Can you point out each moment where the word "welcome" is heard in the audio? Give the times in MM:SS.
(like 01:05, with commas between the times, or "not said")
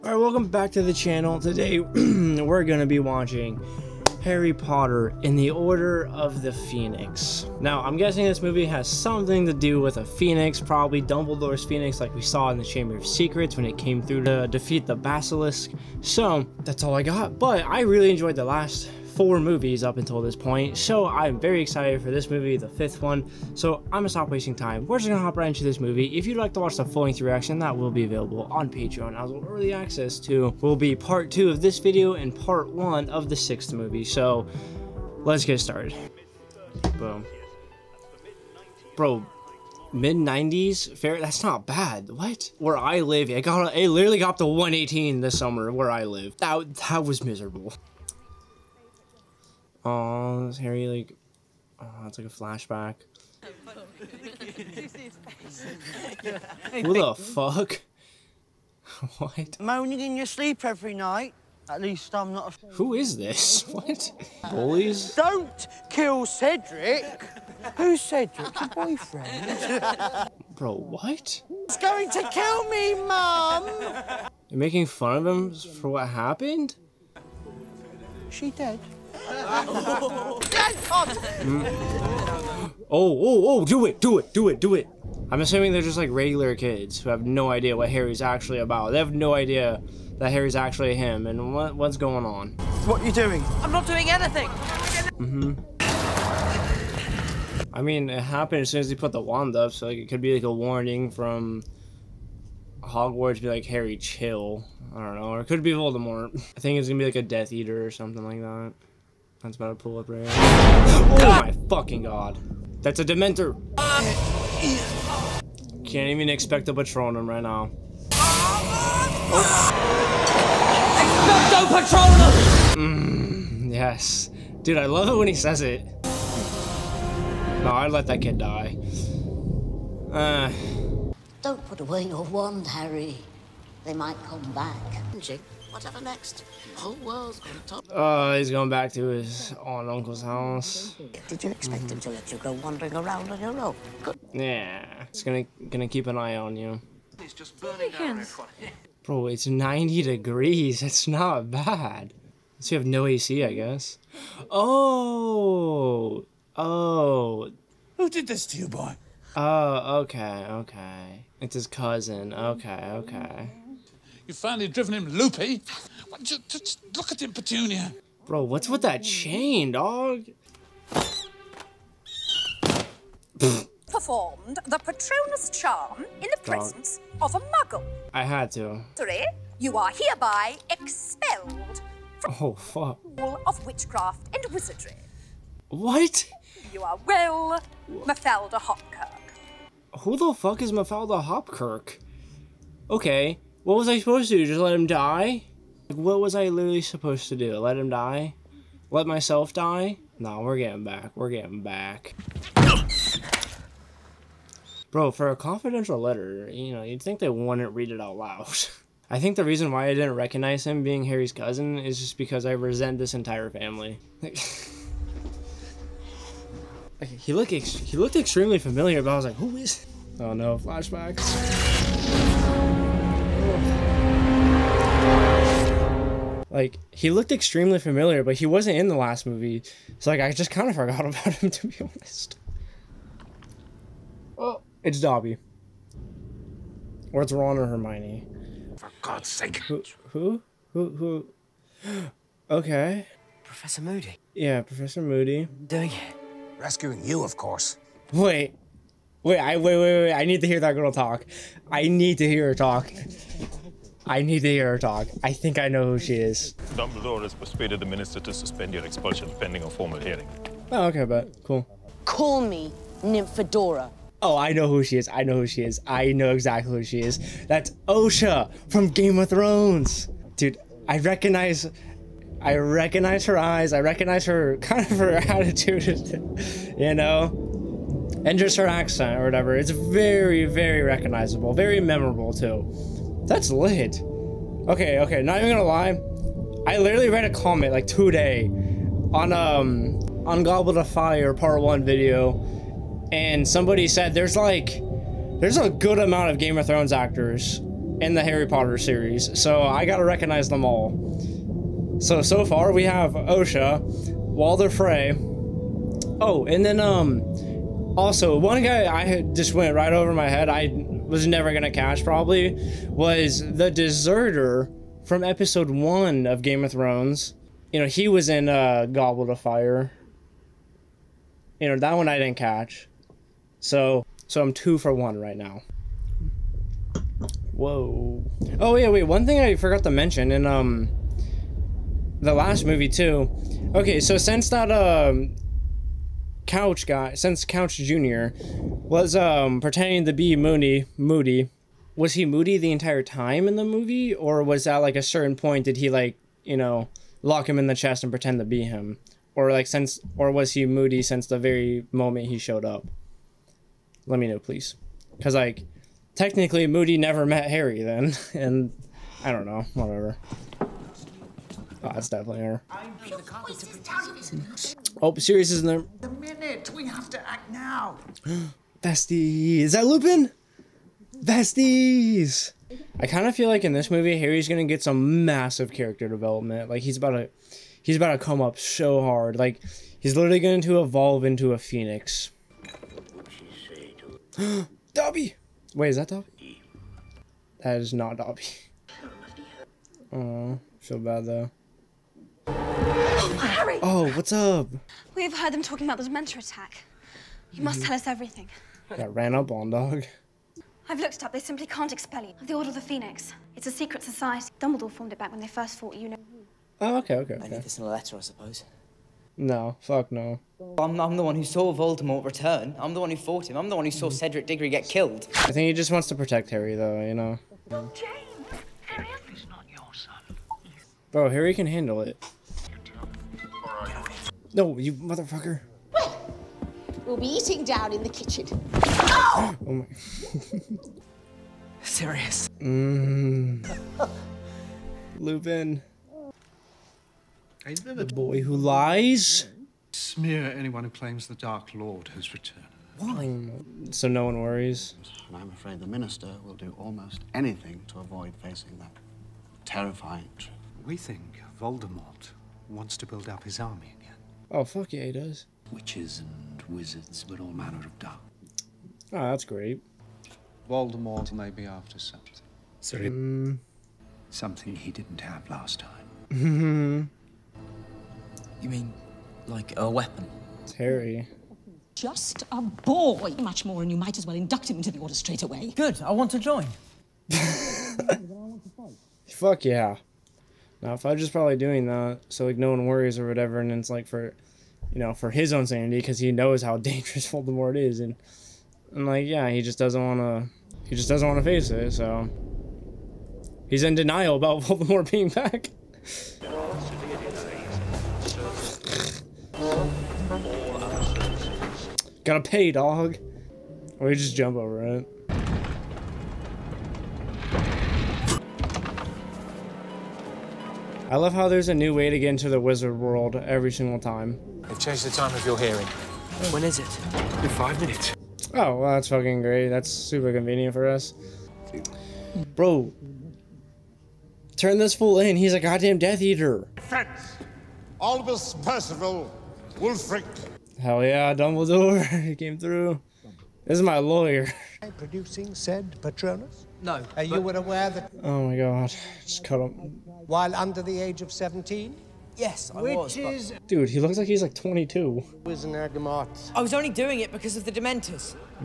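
00:00.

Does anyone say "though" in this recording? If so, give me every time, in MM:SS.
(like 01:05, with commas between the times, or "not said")
06:31, 06:56.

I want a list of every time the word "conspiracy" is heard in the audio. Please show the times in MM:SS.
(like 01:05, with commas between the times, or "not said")
not said.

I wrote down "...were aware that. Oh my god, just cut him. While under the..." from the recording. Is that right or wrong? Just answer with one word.
right.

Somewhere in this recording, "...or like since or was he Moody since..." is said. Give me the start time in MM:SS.
05:49.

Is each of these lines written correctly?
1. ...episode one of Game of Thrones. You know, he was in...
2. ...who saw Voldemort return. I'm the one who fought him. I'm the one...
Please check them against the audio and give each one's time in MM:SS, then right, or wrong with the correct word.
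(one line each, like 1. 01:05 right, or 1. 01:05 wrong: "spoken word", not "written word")
1. 05:15 right
2. 06:51 right.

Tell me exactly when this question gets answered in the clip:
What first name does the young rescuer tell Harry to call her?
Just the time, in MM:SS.
04:23.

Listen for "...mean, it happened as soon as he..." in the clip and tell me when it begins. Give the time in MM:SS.
01:37.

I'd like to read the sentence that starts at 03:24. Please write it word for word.
Bro, for a confidential letter, you know, you'd think they wouldn't read it out loud.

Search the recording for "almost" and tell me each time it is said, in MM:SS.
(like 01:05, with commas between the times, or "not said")
07:26.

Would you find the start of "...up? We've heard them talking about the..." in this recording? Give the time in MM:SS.
06:34.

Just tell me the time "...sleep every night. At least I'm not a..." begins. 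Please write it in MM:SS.
01:00.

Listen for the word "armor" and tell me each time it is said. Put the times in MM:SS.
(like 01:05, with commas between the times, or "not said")
not said.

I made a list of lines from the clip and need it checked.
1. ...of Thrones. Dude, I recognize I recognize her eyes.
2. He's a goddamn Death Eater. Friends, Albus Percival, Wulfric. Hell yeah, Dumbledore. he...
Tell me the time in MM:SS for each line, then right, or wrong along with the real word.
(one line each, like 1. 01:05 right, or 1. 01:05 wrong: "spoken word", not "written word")
1. 04:29 right
2. 08:45 right.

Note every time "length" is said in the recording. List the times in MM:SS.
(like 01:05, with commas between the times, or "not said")
00:27.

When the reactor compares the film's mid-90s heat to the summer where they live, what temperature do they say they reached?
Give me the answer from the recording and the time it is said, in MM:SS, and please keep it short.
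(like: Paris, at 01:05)
118, at 00:44.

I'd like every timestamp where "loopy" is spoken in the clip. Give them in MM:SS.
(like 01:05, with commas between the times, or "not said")
02:45.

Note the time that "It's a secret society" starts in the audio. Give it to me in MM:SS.
06:43.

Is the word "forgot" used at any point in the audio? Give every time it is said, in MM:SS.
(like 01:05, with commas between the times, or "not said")
03:50, 05:29.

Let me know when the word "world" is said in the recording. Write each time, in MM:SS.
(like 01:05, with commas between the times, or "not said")
02:16, 08:32.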